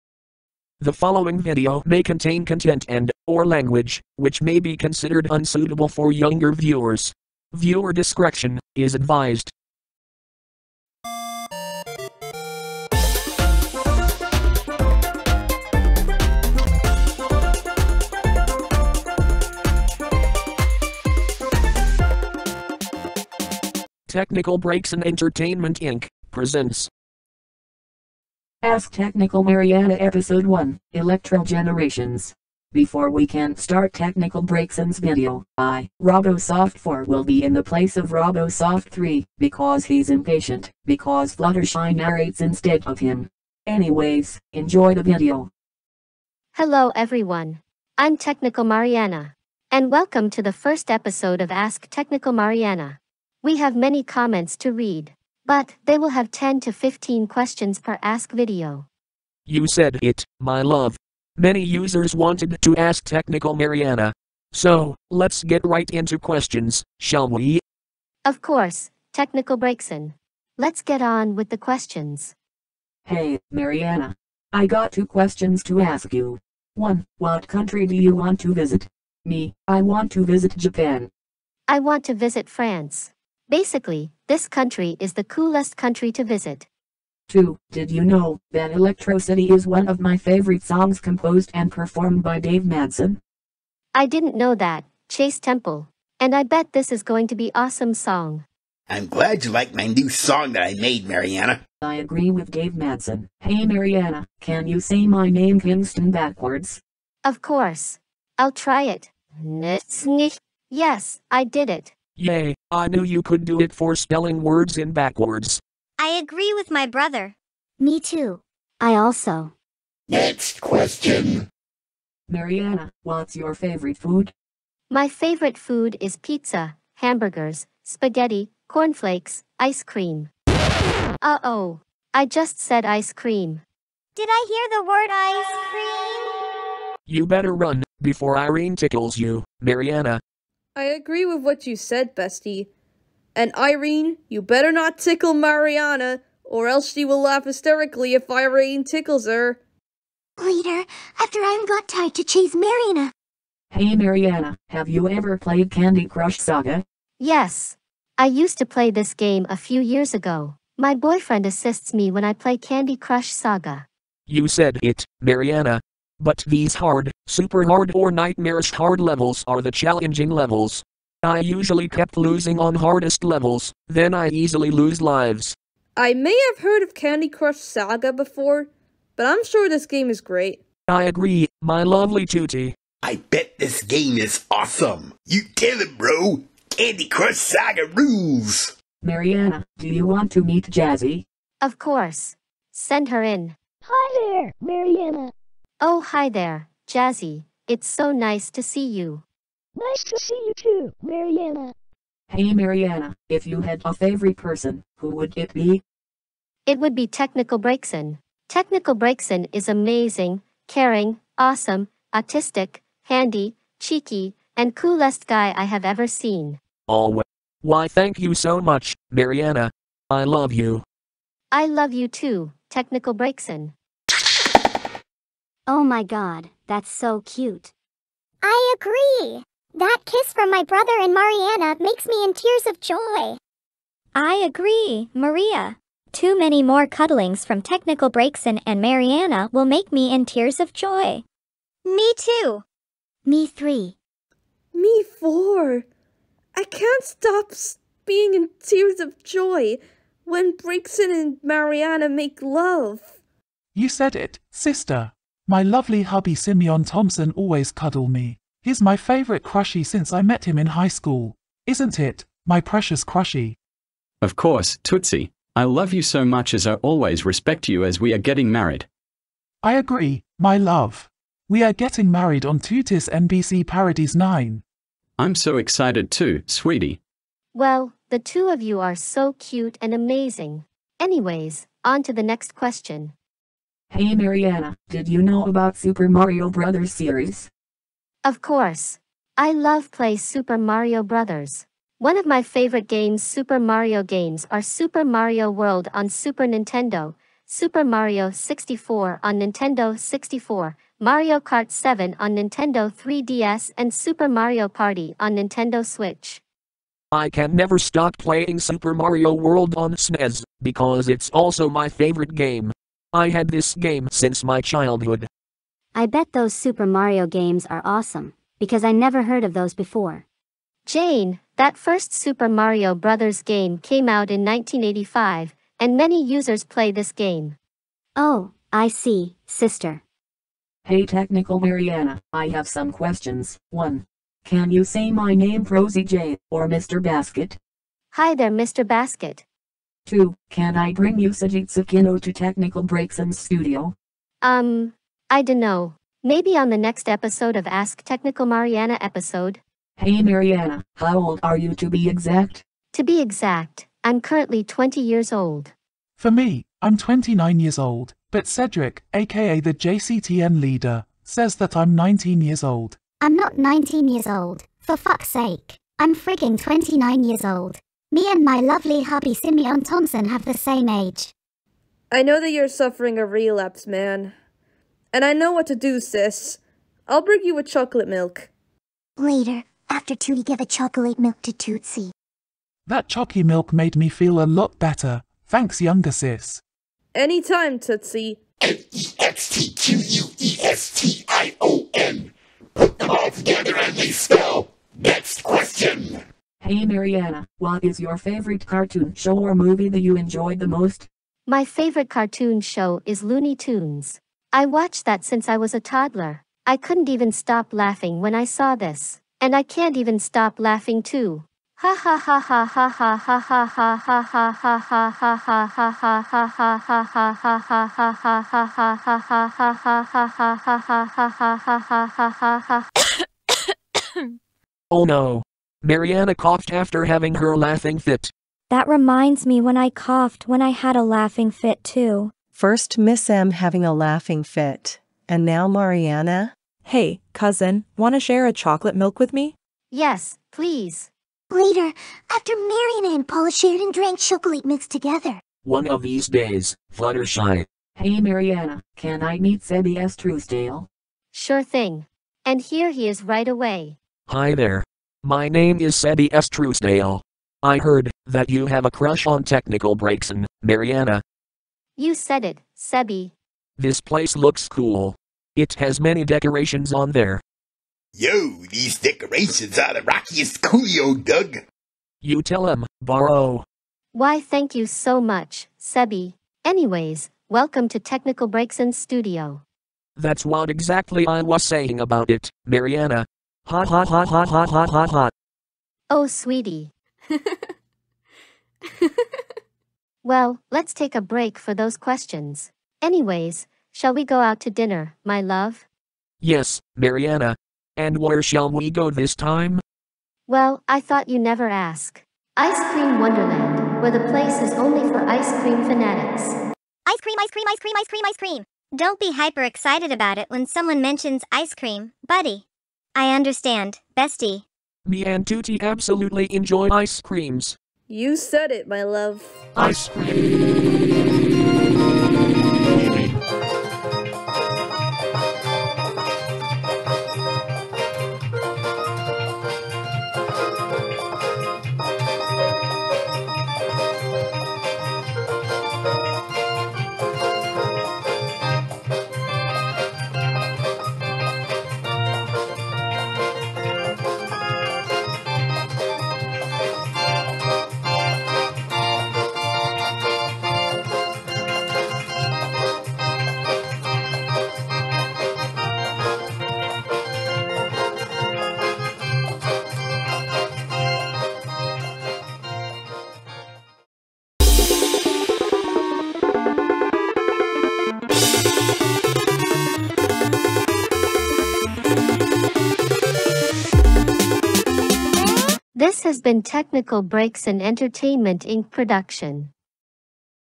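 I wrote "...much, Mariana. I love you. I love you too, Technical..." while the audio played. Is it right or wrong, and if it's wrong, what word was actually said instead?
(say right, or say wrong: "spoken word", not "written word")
right.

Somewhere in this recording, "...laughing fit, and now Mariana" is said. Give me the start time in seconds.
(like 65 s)
433 s.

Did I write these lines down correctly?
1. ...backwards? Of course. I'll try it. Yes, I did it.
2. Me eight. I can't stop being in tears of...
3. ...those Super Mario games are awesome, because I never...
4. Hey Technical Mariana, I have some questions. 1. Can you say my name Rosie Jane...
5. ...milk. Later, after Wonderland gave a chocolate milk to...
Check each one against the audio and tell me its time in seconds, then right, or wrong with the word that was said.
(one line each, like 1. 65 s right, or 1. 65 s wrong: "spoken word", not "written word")
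1. 106 s right
2. 244 s wrong: "four", not "eight"
3. 316 s right
4. 330 s right
5. 378 s wrong: "Tootie", not "Wonderland".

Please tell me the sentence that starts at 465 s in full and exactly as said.
It has many decorations on there.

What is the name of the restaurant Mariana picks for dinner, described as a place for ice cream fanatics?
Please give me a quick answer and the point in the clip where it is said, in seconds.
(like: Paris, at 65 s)
Ice Cream Wonderland, at 502 s.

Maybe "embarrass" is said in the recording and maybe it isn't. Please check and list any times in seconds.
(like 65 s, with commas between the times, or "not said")
not said.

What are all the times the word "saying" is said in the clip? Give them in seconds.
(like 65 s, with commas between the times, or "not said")
481 s.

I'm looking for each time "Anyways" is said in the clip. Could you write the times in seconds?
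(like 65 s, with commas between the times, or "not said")
43 s, 280 s, 476 s, 493 s.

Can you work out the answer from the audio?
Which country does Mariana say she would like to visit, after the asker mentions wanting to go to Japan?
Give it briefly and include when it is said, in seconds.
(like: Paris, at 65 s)
France, at 82 s.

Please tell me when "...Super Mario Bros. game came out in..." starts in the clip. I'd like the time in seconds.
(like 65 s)
322 s.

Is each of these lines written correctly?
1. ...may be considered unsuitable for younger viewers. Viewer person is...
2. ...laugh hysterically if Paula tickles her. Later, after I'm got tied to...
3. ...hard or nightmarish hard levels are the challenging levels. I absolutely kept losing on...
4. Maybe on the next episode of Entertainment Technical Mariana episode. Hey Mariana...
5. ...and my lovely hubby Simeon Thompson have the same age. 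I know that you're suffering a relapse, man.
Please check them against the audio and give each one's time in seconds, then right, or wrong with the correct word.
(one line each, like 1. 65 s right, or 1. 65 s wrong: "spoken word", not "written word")
1. 4 s wrong: "discretion", not "person"
2. 147 s wrong: "Irene", not "Paula"
3. 167 s wrong: "usually", not "absolutely"
4. 346 s wrong: "Ask", not "Entertainment"
5. 368 s right.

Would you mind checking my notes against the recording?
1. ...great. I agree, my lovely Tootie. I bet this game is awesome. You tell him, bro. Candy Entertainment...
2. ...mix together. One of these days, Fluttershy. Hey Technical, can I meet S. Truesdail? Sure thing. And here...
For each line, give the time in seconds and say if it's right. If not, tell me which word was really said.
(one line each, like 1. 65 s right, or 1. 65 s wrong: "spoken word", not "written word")
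1. 180 s wrong: "Crush", not "Entertainment"
2. 444 s wrong: "Mariana", not "Technical".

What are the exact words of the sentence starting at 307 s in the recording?
I can never stop playing Super Mario World on SNES, because it's also my favorite game.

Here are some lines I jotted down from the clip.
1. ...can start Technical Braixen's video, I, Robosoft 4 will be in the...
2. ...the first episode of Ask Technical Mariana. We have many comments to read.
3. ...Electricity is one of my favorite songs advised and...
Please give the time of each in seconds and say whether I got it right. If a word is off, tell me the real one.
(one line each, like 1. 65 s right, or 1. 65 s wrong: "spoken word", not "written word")
1. 33 s right
2. 50 s right
3. 88 s wrong: "composed", not "advised".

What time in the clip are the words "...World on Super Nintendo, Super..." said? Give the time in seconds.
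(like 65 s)
295 s.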